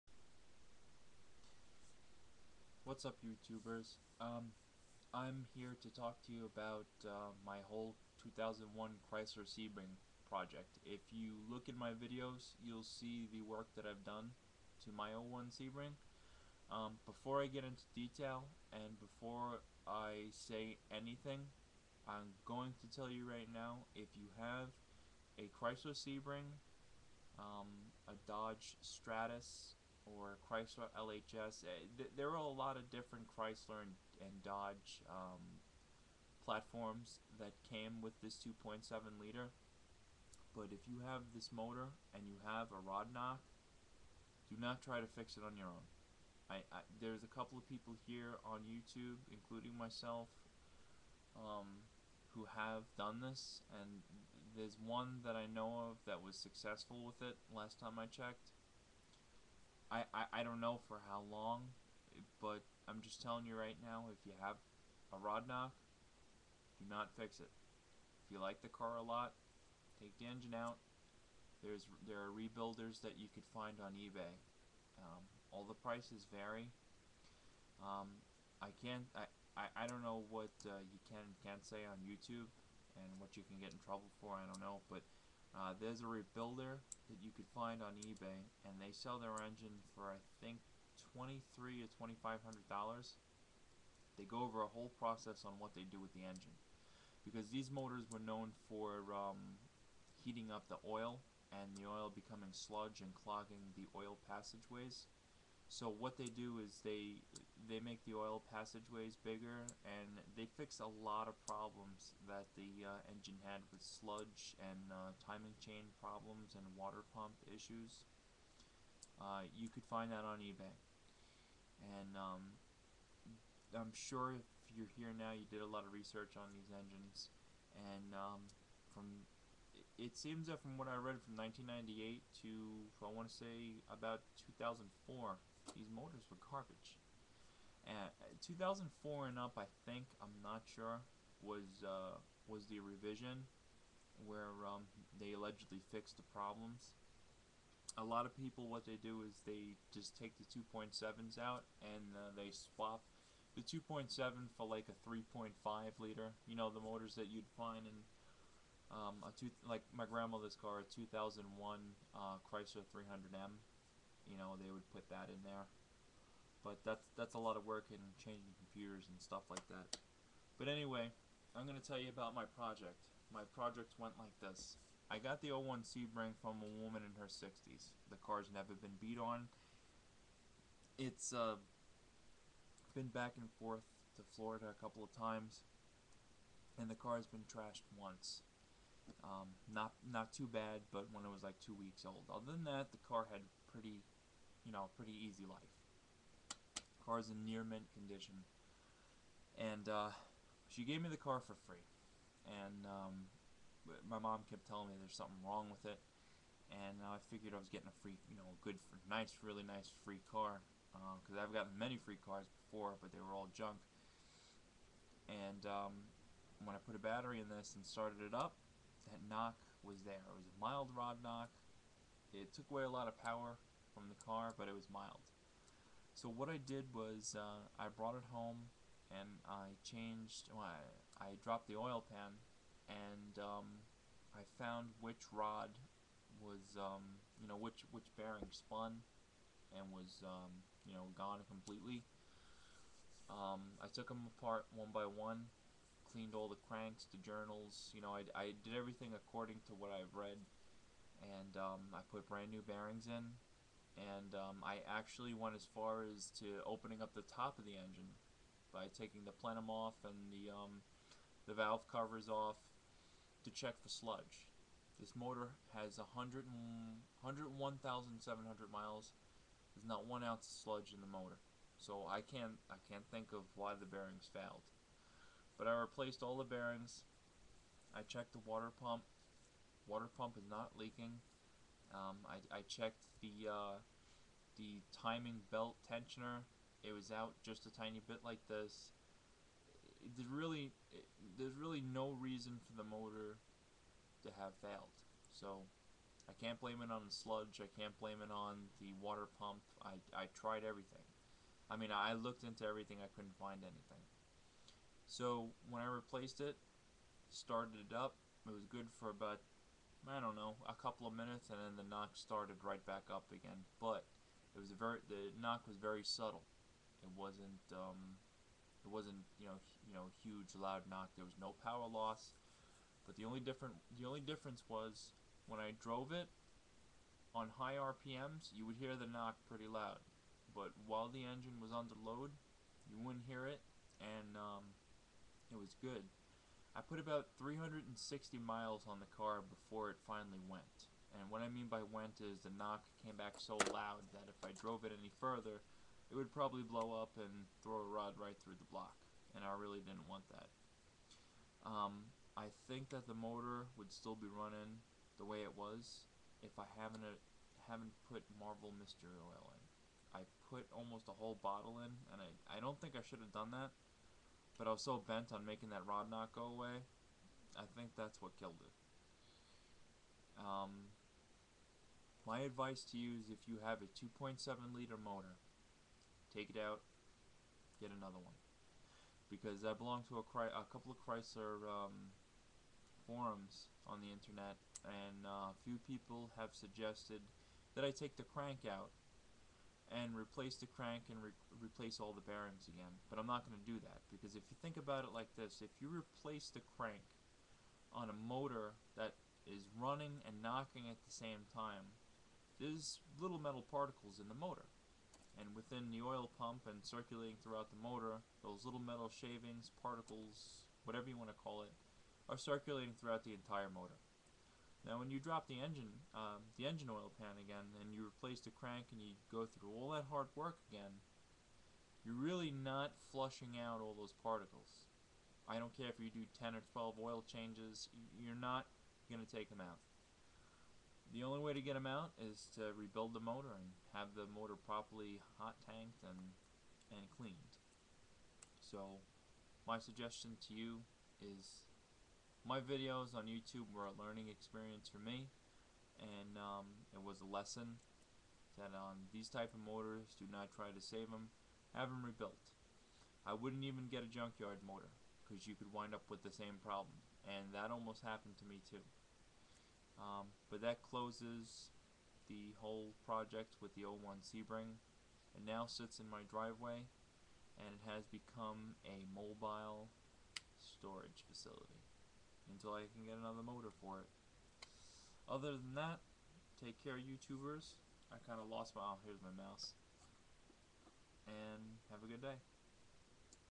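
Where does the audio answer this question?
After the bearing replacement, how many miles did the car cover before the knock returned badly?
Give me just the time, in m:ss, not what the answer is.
5:37.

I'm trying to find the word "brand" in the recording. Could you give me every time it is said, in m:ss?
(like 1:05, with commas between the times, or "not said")
4:12.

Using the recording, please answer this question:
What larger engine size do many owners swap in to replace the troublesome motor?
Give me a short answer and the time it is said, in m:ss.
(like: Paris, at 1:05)
3.5 liter, at 2:35.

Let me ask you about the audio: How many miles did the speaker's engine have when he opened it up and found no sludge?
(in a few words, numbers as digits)
101,700.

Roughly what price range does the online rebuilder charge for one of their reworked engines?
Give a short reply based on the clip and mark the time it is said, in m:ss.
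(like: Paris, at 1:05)
$2,300 to $2,500, at 1:31.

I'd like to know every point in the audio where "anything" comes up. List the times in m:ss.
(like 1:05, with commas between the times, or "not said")
0:20, 5:03.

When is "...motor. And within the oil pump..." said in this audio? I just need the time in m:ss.
6:44.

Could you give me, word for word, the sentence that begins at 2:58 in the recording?
The car's never been beat on.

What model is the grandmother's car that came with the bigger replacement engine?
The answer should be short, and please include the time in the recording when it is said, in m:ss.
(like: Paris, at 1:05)
Chrysler 300M, at 2:42.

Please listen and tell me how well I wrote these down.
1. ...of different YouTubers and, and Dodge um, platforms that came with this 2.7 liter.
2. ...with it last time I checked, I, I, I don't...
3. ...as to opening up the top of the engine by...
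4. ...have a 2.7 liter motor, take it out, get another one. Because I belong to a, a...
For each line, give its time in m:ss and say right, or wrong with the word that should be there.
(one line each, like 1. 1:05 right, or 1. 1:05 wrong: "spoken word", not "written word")
1. 0:32 wrong: "Chrysler", not "YouTubers"
2. 0:57 right
3. 4:16 right
4. 6:13 right.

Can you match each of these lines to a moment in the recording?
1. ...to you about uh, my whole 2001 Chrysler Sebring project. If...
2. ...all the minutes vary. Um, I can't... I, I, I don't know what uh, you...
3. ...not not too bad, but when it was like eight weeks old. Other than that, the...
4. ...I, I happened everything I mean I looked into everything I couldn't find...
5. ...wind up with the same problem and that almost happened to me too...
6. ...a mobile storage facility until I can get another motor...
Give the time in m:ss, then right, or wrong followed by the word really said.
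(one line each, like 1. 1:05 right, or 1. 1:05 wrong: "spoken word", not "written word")
1. 0:06 right
2. 1:15 wrong: "prices", not "minutes"
3. 3:09 wrong: "two", not "eight"
4. 4:59 wrong: "tried", not "happened"
5. 7:35 right
6. 7:48 right.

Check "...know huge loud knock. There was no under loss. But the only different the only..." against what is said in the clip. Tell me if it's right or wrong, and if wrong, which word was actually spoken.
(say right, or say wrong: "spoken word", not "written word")
wrong: "power", not "under".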